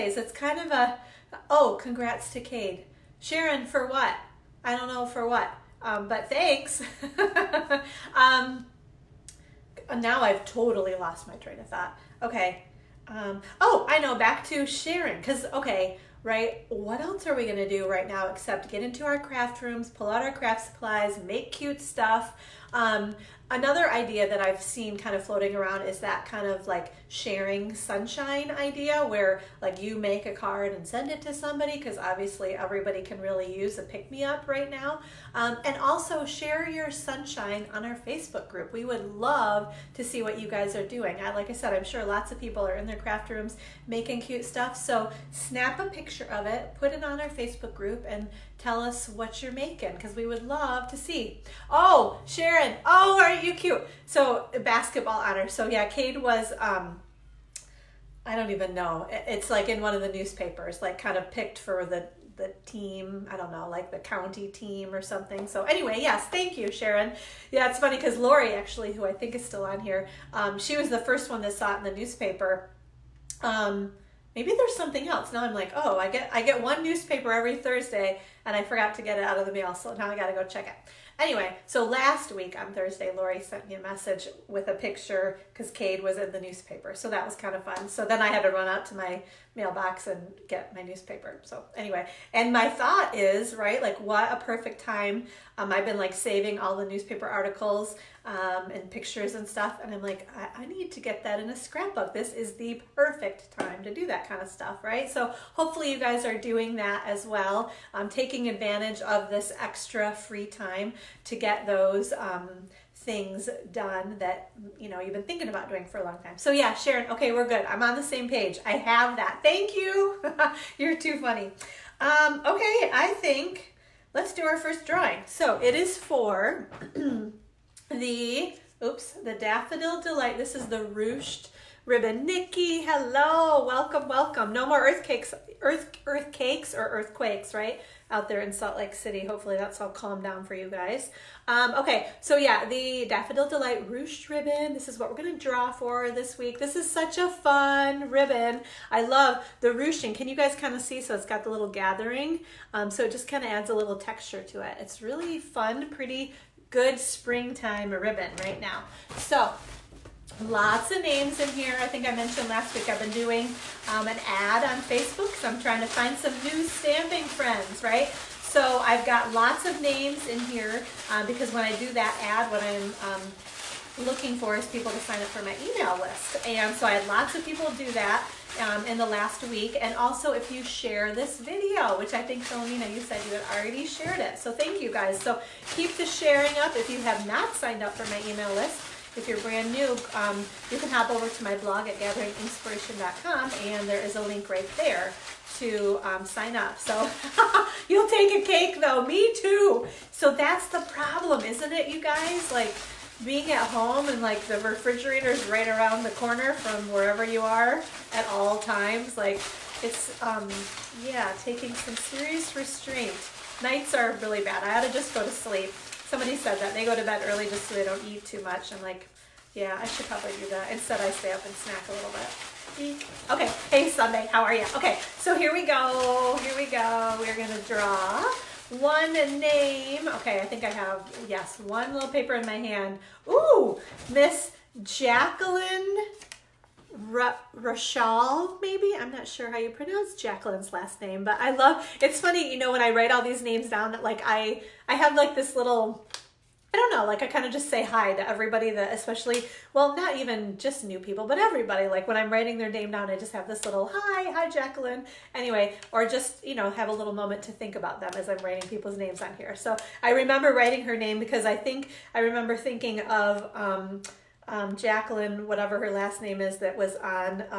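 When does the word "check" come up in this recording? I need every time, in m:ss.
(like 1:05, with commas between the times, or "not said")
1:20.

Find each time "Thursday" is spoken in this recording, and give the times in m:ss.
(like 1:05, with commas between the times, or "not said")
1:17, 1:22.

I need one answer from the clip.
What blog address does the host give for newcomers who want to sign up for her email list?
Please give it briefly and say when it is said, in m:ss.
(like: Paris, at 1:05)
gatheringinkspiration.com, at 3:11.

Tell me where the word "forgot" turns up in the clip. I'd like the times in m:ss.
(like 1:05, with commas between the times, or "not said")
1:18.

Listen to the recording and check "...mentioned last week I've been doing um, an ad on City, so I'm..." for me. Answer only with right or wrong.
wrong.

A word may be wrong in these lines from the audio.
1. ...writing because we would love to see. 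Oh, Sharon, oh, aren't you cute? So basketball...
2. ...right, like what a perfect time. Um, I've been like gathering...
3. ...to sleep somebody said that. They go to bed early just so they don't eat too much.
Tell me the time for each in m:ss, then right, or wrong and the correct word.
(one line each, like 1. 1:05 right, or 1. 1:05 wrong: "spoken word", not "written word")
1. 0:49 wrong: "making", not "writing"
2. 1:33 wrong: "saving", not "gathering"
3. 3:35 right.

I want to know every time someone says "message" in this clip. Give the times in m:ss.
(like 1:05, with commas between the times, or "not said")
1:23.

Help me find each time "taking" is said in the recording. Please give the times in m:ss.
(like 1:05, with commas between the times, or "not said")
1:48, 3:31.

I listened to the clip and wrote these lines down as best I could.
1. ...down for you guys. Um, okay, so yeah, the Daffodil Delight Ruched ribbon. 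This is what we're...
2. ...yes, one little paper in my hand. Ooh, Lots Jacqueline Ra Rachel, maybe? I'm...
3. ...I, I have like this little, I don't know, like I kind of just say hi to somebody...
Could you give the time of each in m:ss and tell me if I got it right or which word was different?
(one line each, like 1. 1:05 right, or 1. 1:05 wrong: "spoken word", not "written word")
1. 2:20 right
2. 3:51 wrong: "Miss", not "Lots"
3. 4:04 wrong: "everybody", not "somebody".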